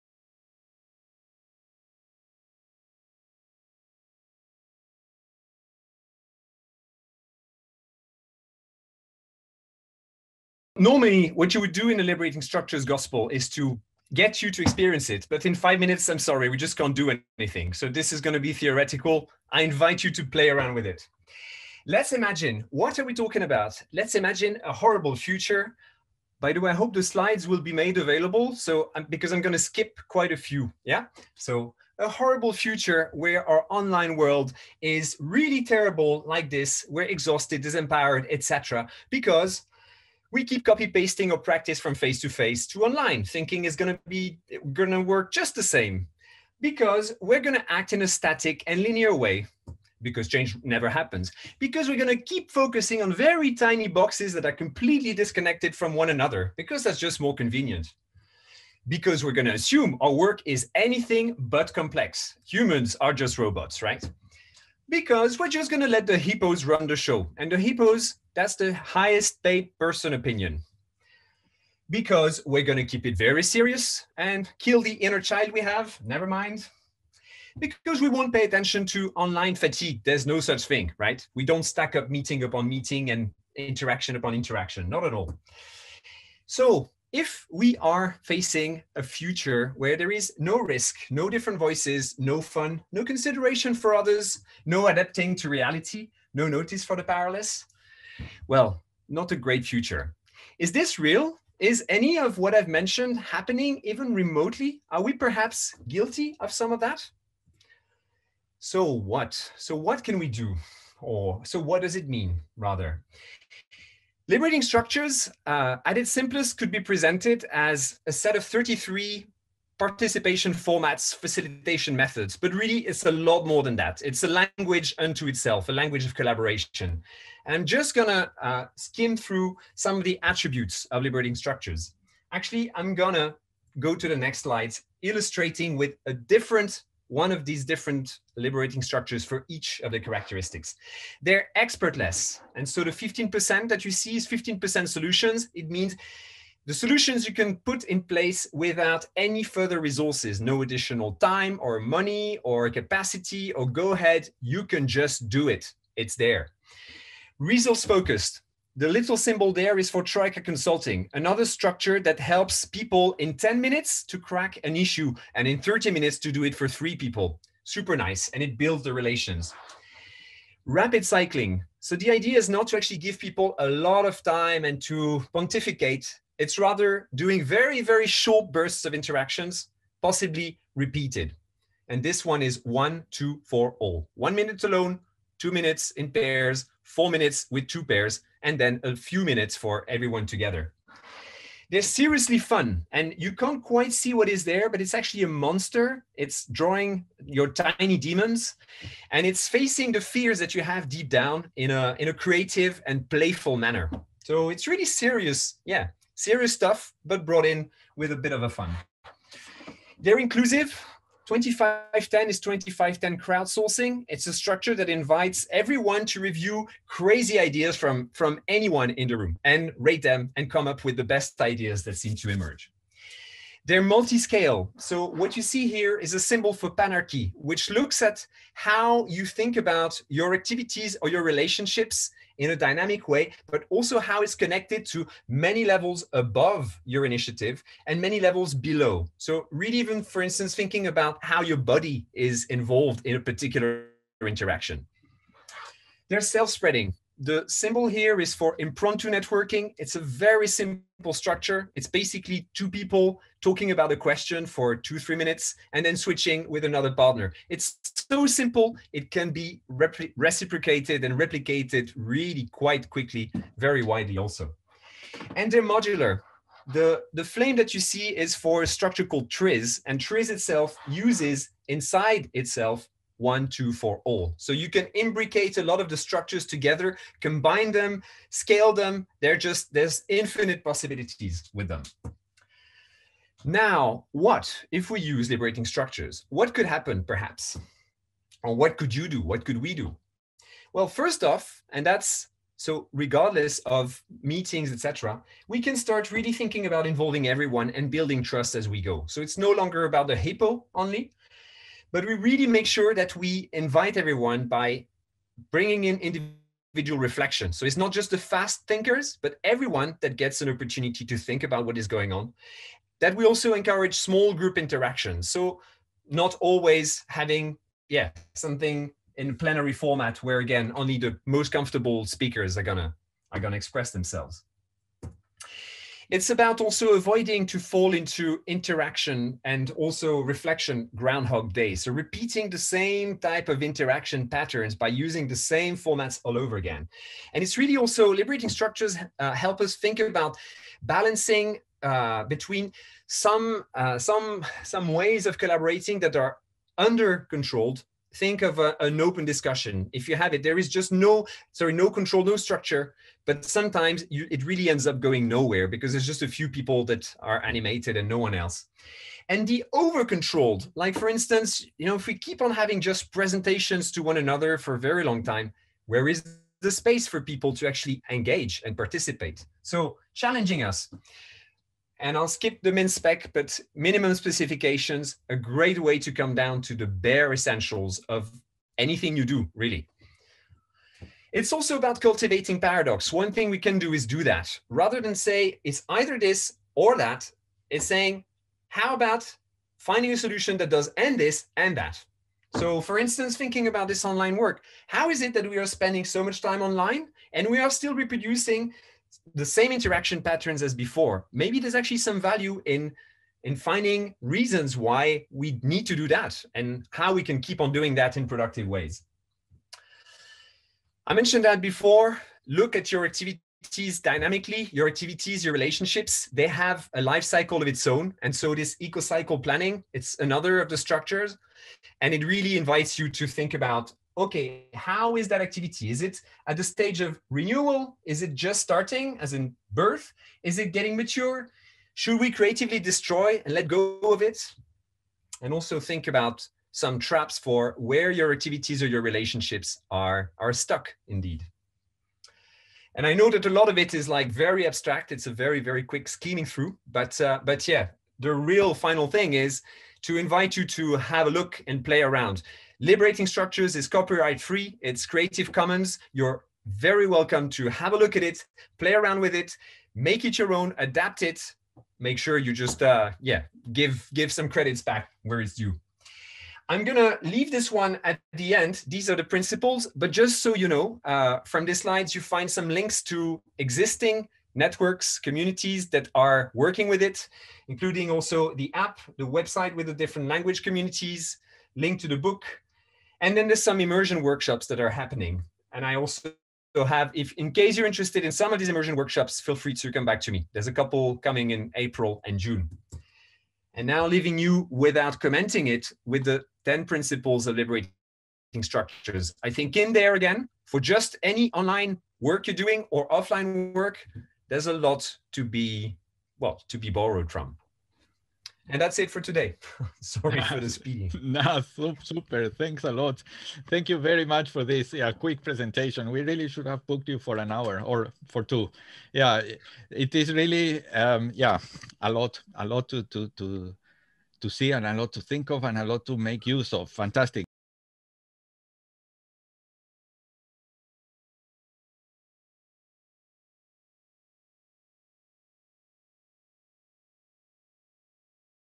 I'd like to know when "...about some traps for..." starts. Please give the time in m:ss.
7:16.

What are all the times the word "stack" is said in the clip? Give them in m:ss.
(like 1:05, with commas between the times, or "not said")
1:21.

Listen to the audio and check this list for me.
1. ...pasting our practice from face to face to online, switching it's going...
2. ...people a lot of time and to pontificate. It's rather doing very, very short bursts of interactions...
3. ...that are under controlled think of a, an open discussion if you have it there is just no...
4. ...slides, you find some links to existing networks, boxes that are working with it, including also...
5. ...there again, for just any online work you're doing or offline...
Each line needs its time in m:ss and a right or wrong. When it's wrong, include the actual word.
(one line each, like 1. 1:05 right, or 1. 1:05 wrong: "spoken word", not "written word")
1. 0:40 wrong: "thinking", not "switching"
2. 2:53 right
3. 5:46 right
4. 7:51 wrong: "communities", not "boxes"
5. 8:19 right.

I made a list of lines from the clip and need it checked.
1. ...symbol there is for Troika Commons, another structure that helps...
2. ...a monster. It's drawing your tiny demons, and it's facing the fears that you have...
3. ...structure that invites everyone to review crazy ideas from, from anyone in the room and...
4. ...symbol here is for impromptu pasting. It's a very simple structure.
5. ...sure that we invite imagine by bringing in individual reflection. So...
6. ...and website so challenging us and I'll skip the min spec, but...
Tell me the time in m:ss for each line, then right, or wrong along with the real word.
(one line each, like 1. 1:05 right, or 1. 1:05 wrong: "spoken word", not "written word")
1. 2:39 wrong: "Consulting", not "Commons"
2. 3:15 right
3. 3:34 right
4. 4:07 wrong: "networking", not "pasting"
5. 5:02 wrong: "everyone", not "imagine"
6. 6:08 wrong: "participate", not "website".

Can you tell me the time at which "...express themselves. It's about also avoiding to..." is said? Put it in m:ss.
5:23.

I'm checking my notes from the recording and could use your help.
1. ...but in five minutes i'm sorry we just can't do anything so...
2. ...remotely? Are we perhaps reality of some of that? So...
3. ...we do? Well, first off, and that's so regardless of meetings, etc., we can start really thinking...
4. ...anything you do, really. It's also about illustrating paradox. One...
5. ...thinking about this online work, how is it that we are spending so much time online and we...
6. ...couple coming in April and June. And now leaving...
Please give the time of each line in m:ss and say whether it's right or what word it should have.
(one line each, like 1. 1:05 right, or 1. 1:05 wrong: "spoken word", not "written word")
1. 0:15 right
2. 1:44 wrong: "guilty", not "reality"
3. 4:49 right
4. 6:18 wrong: "cultivating", not "illustrating"
5. 6:33 right
6. 8:10 right.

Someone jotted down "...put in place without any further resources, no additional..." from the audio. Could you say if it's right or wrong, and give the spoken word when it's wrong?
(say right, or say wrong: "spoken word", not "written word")
right.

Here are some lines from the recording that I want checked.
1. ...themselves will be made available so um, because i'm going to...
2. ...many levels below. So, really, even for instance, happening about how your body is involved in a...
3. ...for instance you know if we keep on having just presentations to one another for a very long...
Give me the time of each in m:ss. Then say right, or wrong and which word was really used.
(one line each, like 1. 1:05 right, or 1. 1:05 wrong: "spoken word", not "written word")
1. 0:27 wrong: "slides", not "themselves"
2. 3:58 wrong: "thinking", not "happening"
3. 6:00 right.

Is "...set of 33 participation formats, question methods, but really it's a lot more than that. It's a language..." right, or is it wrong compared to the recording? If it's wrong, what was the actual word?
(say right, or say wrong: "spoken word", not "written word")
wrong: "facilitation", not "question".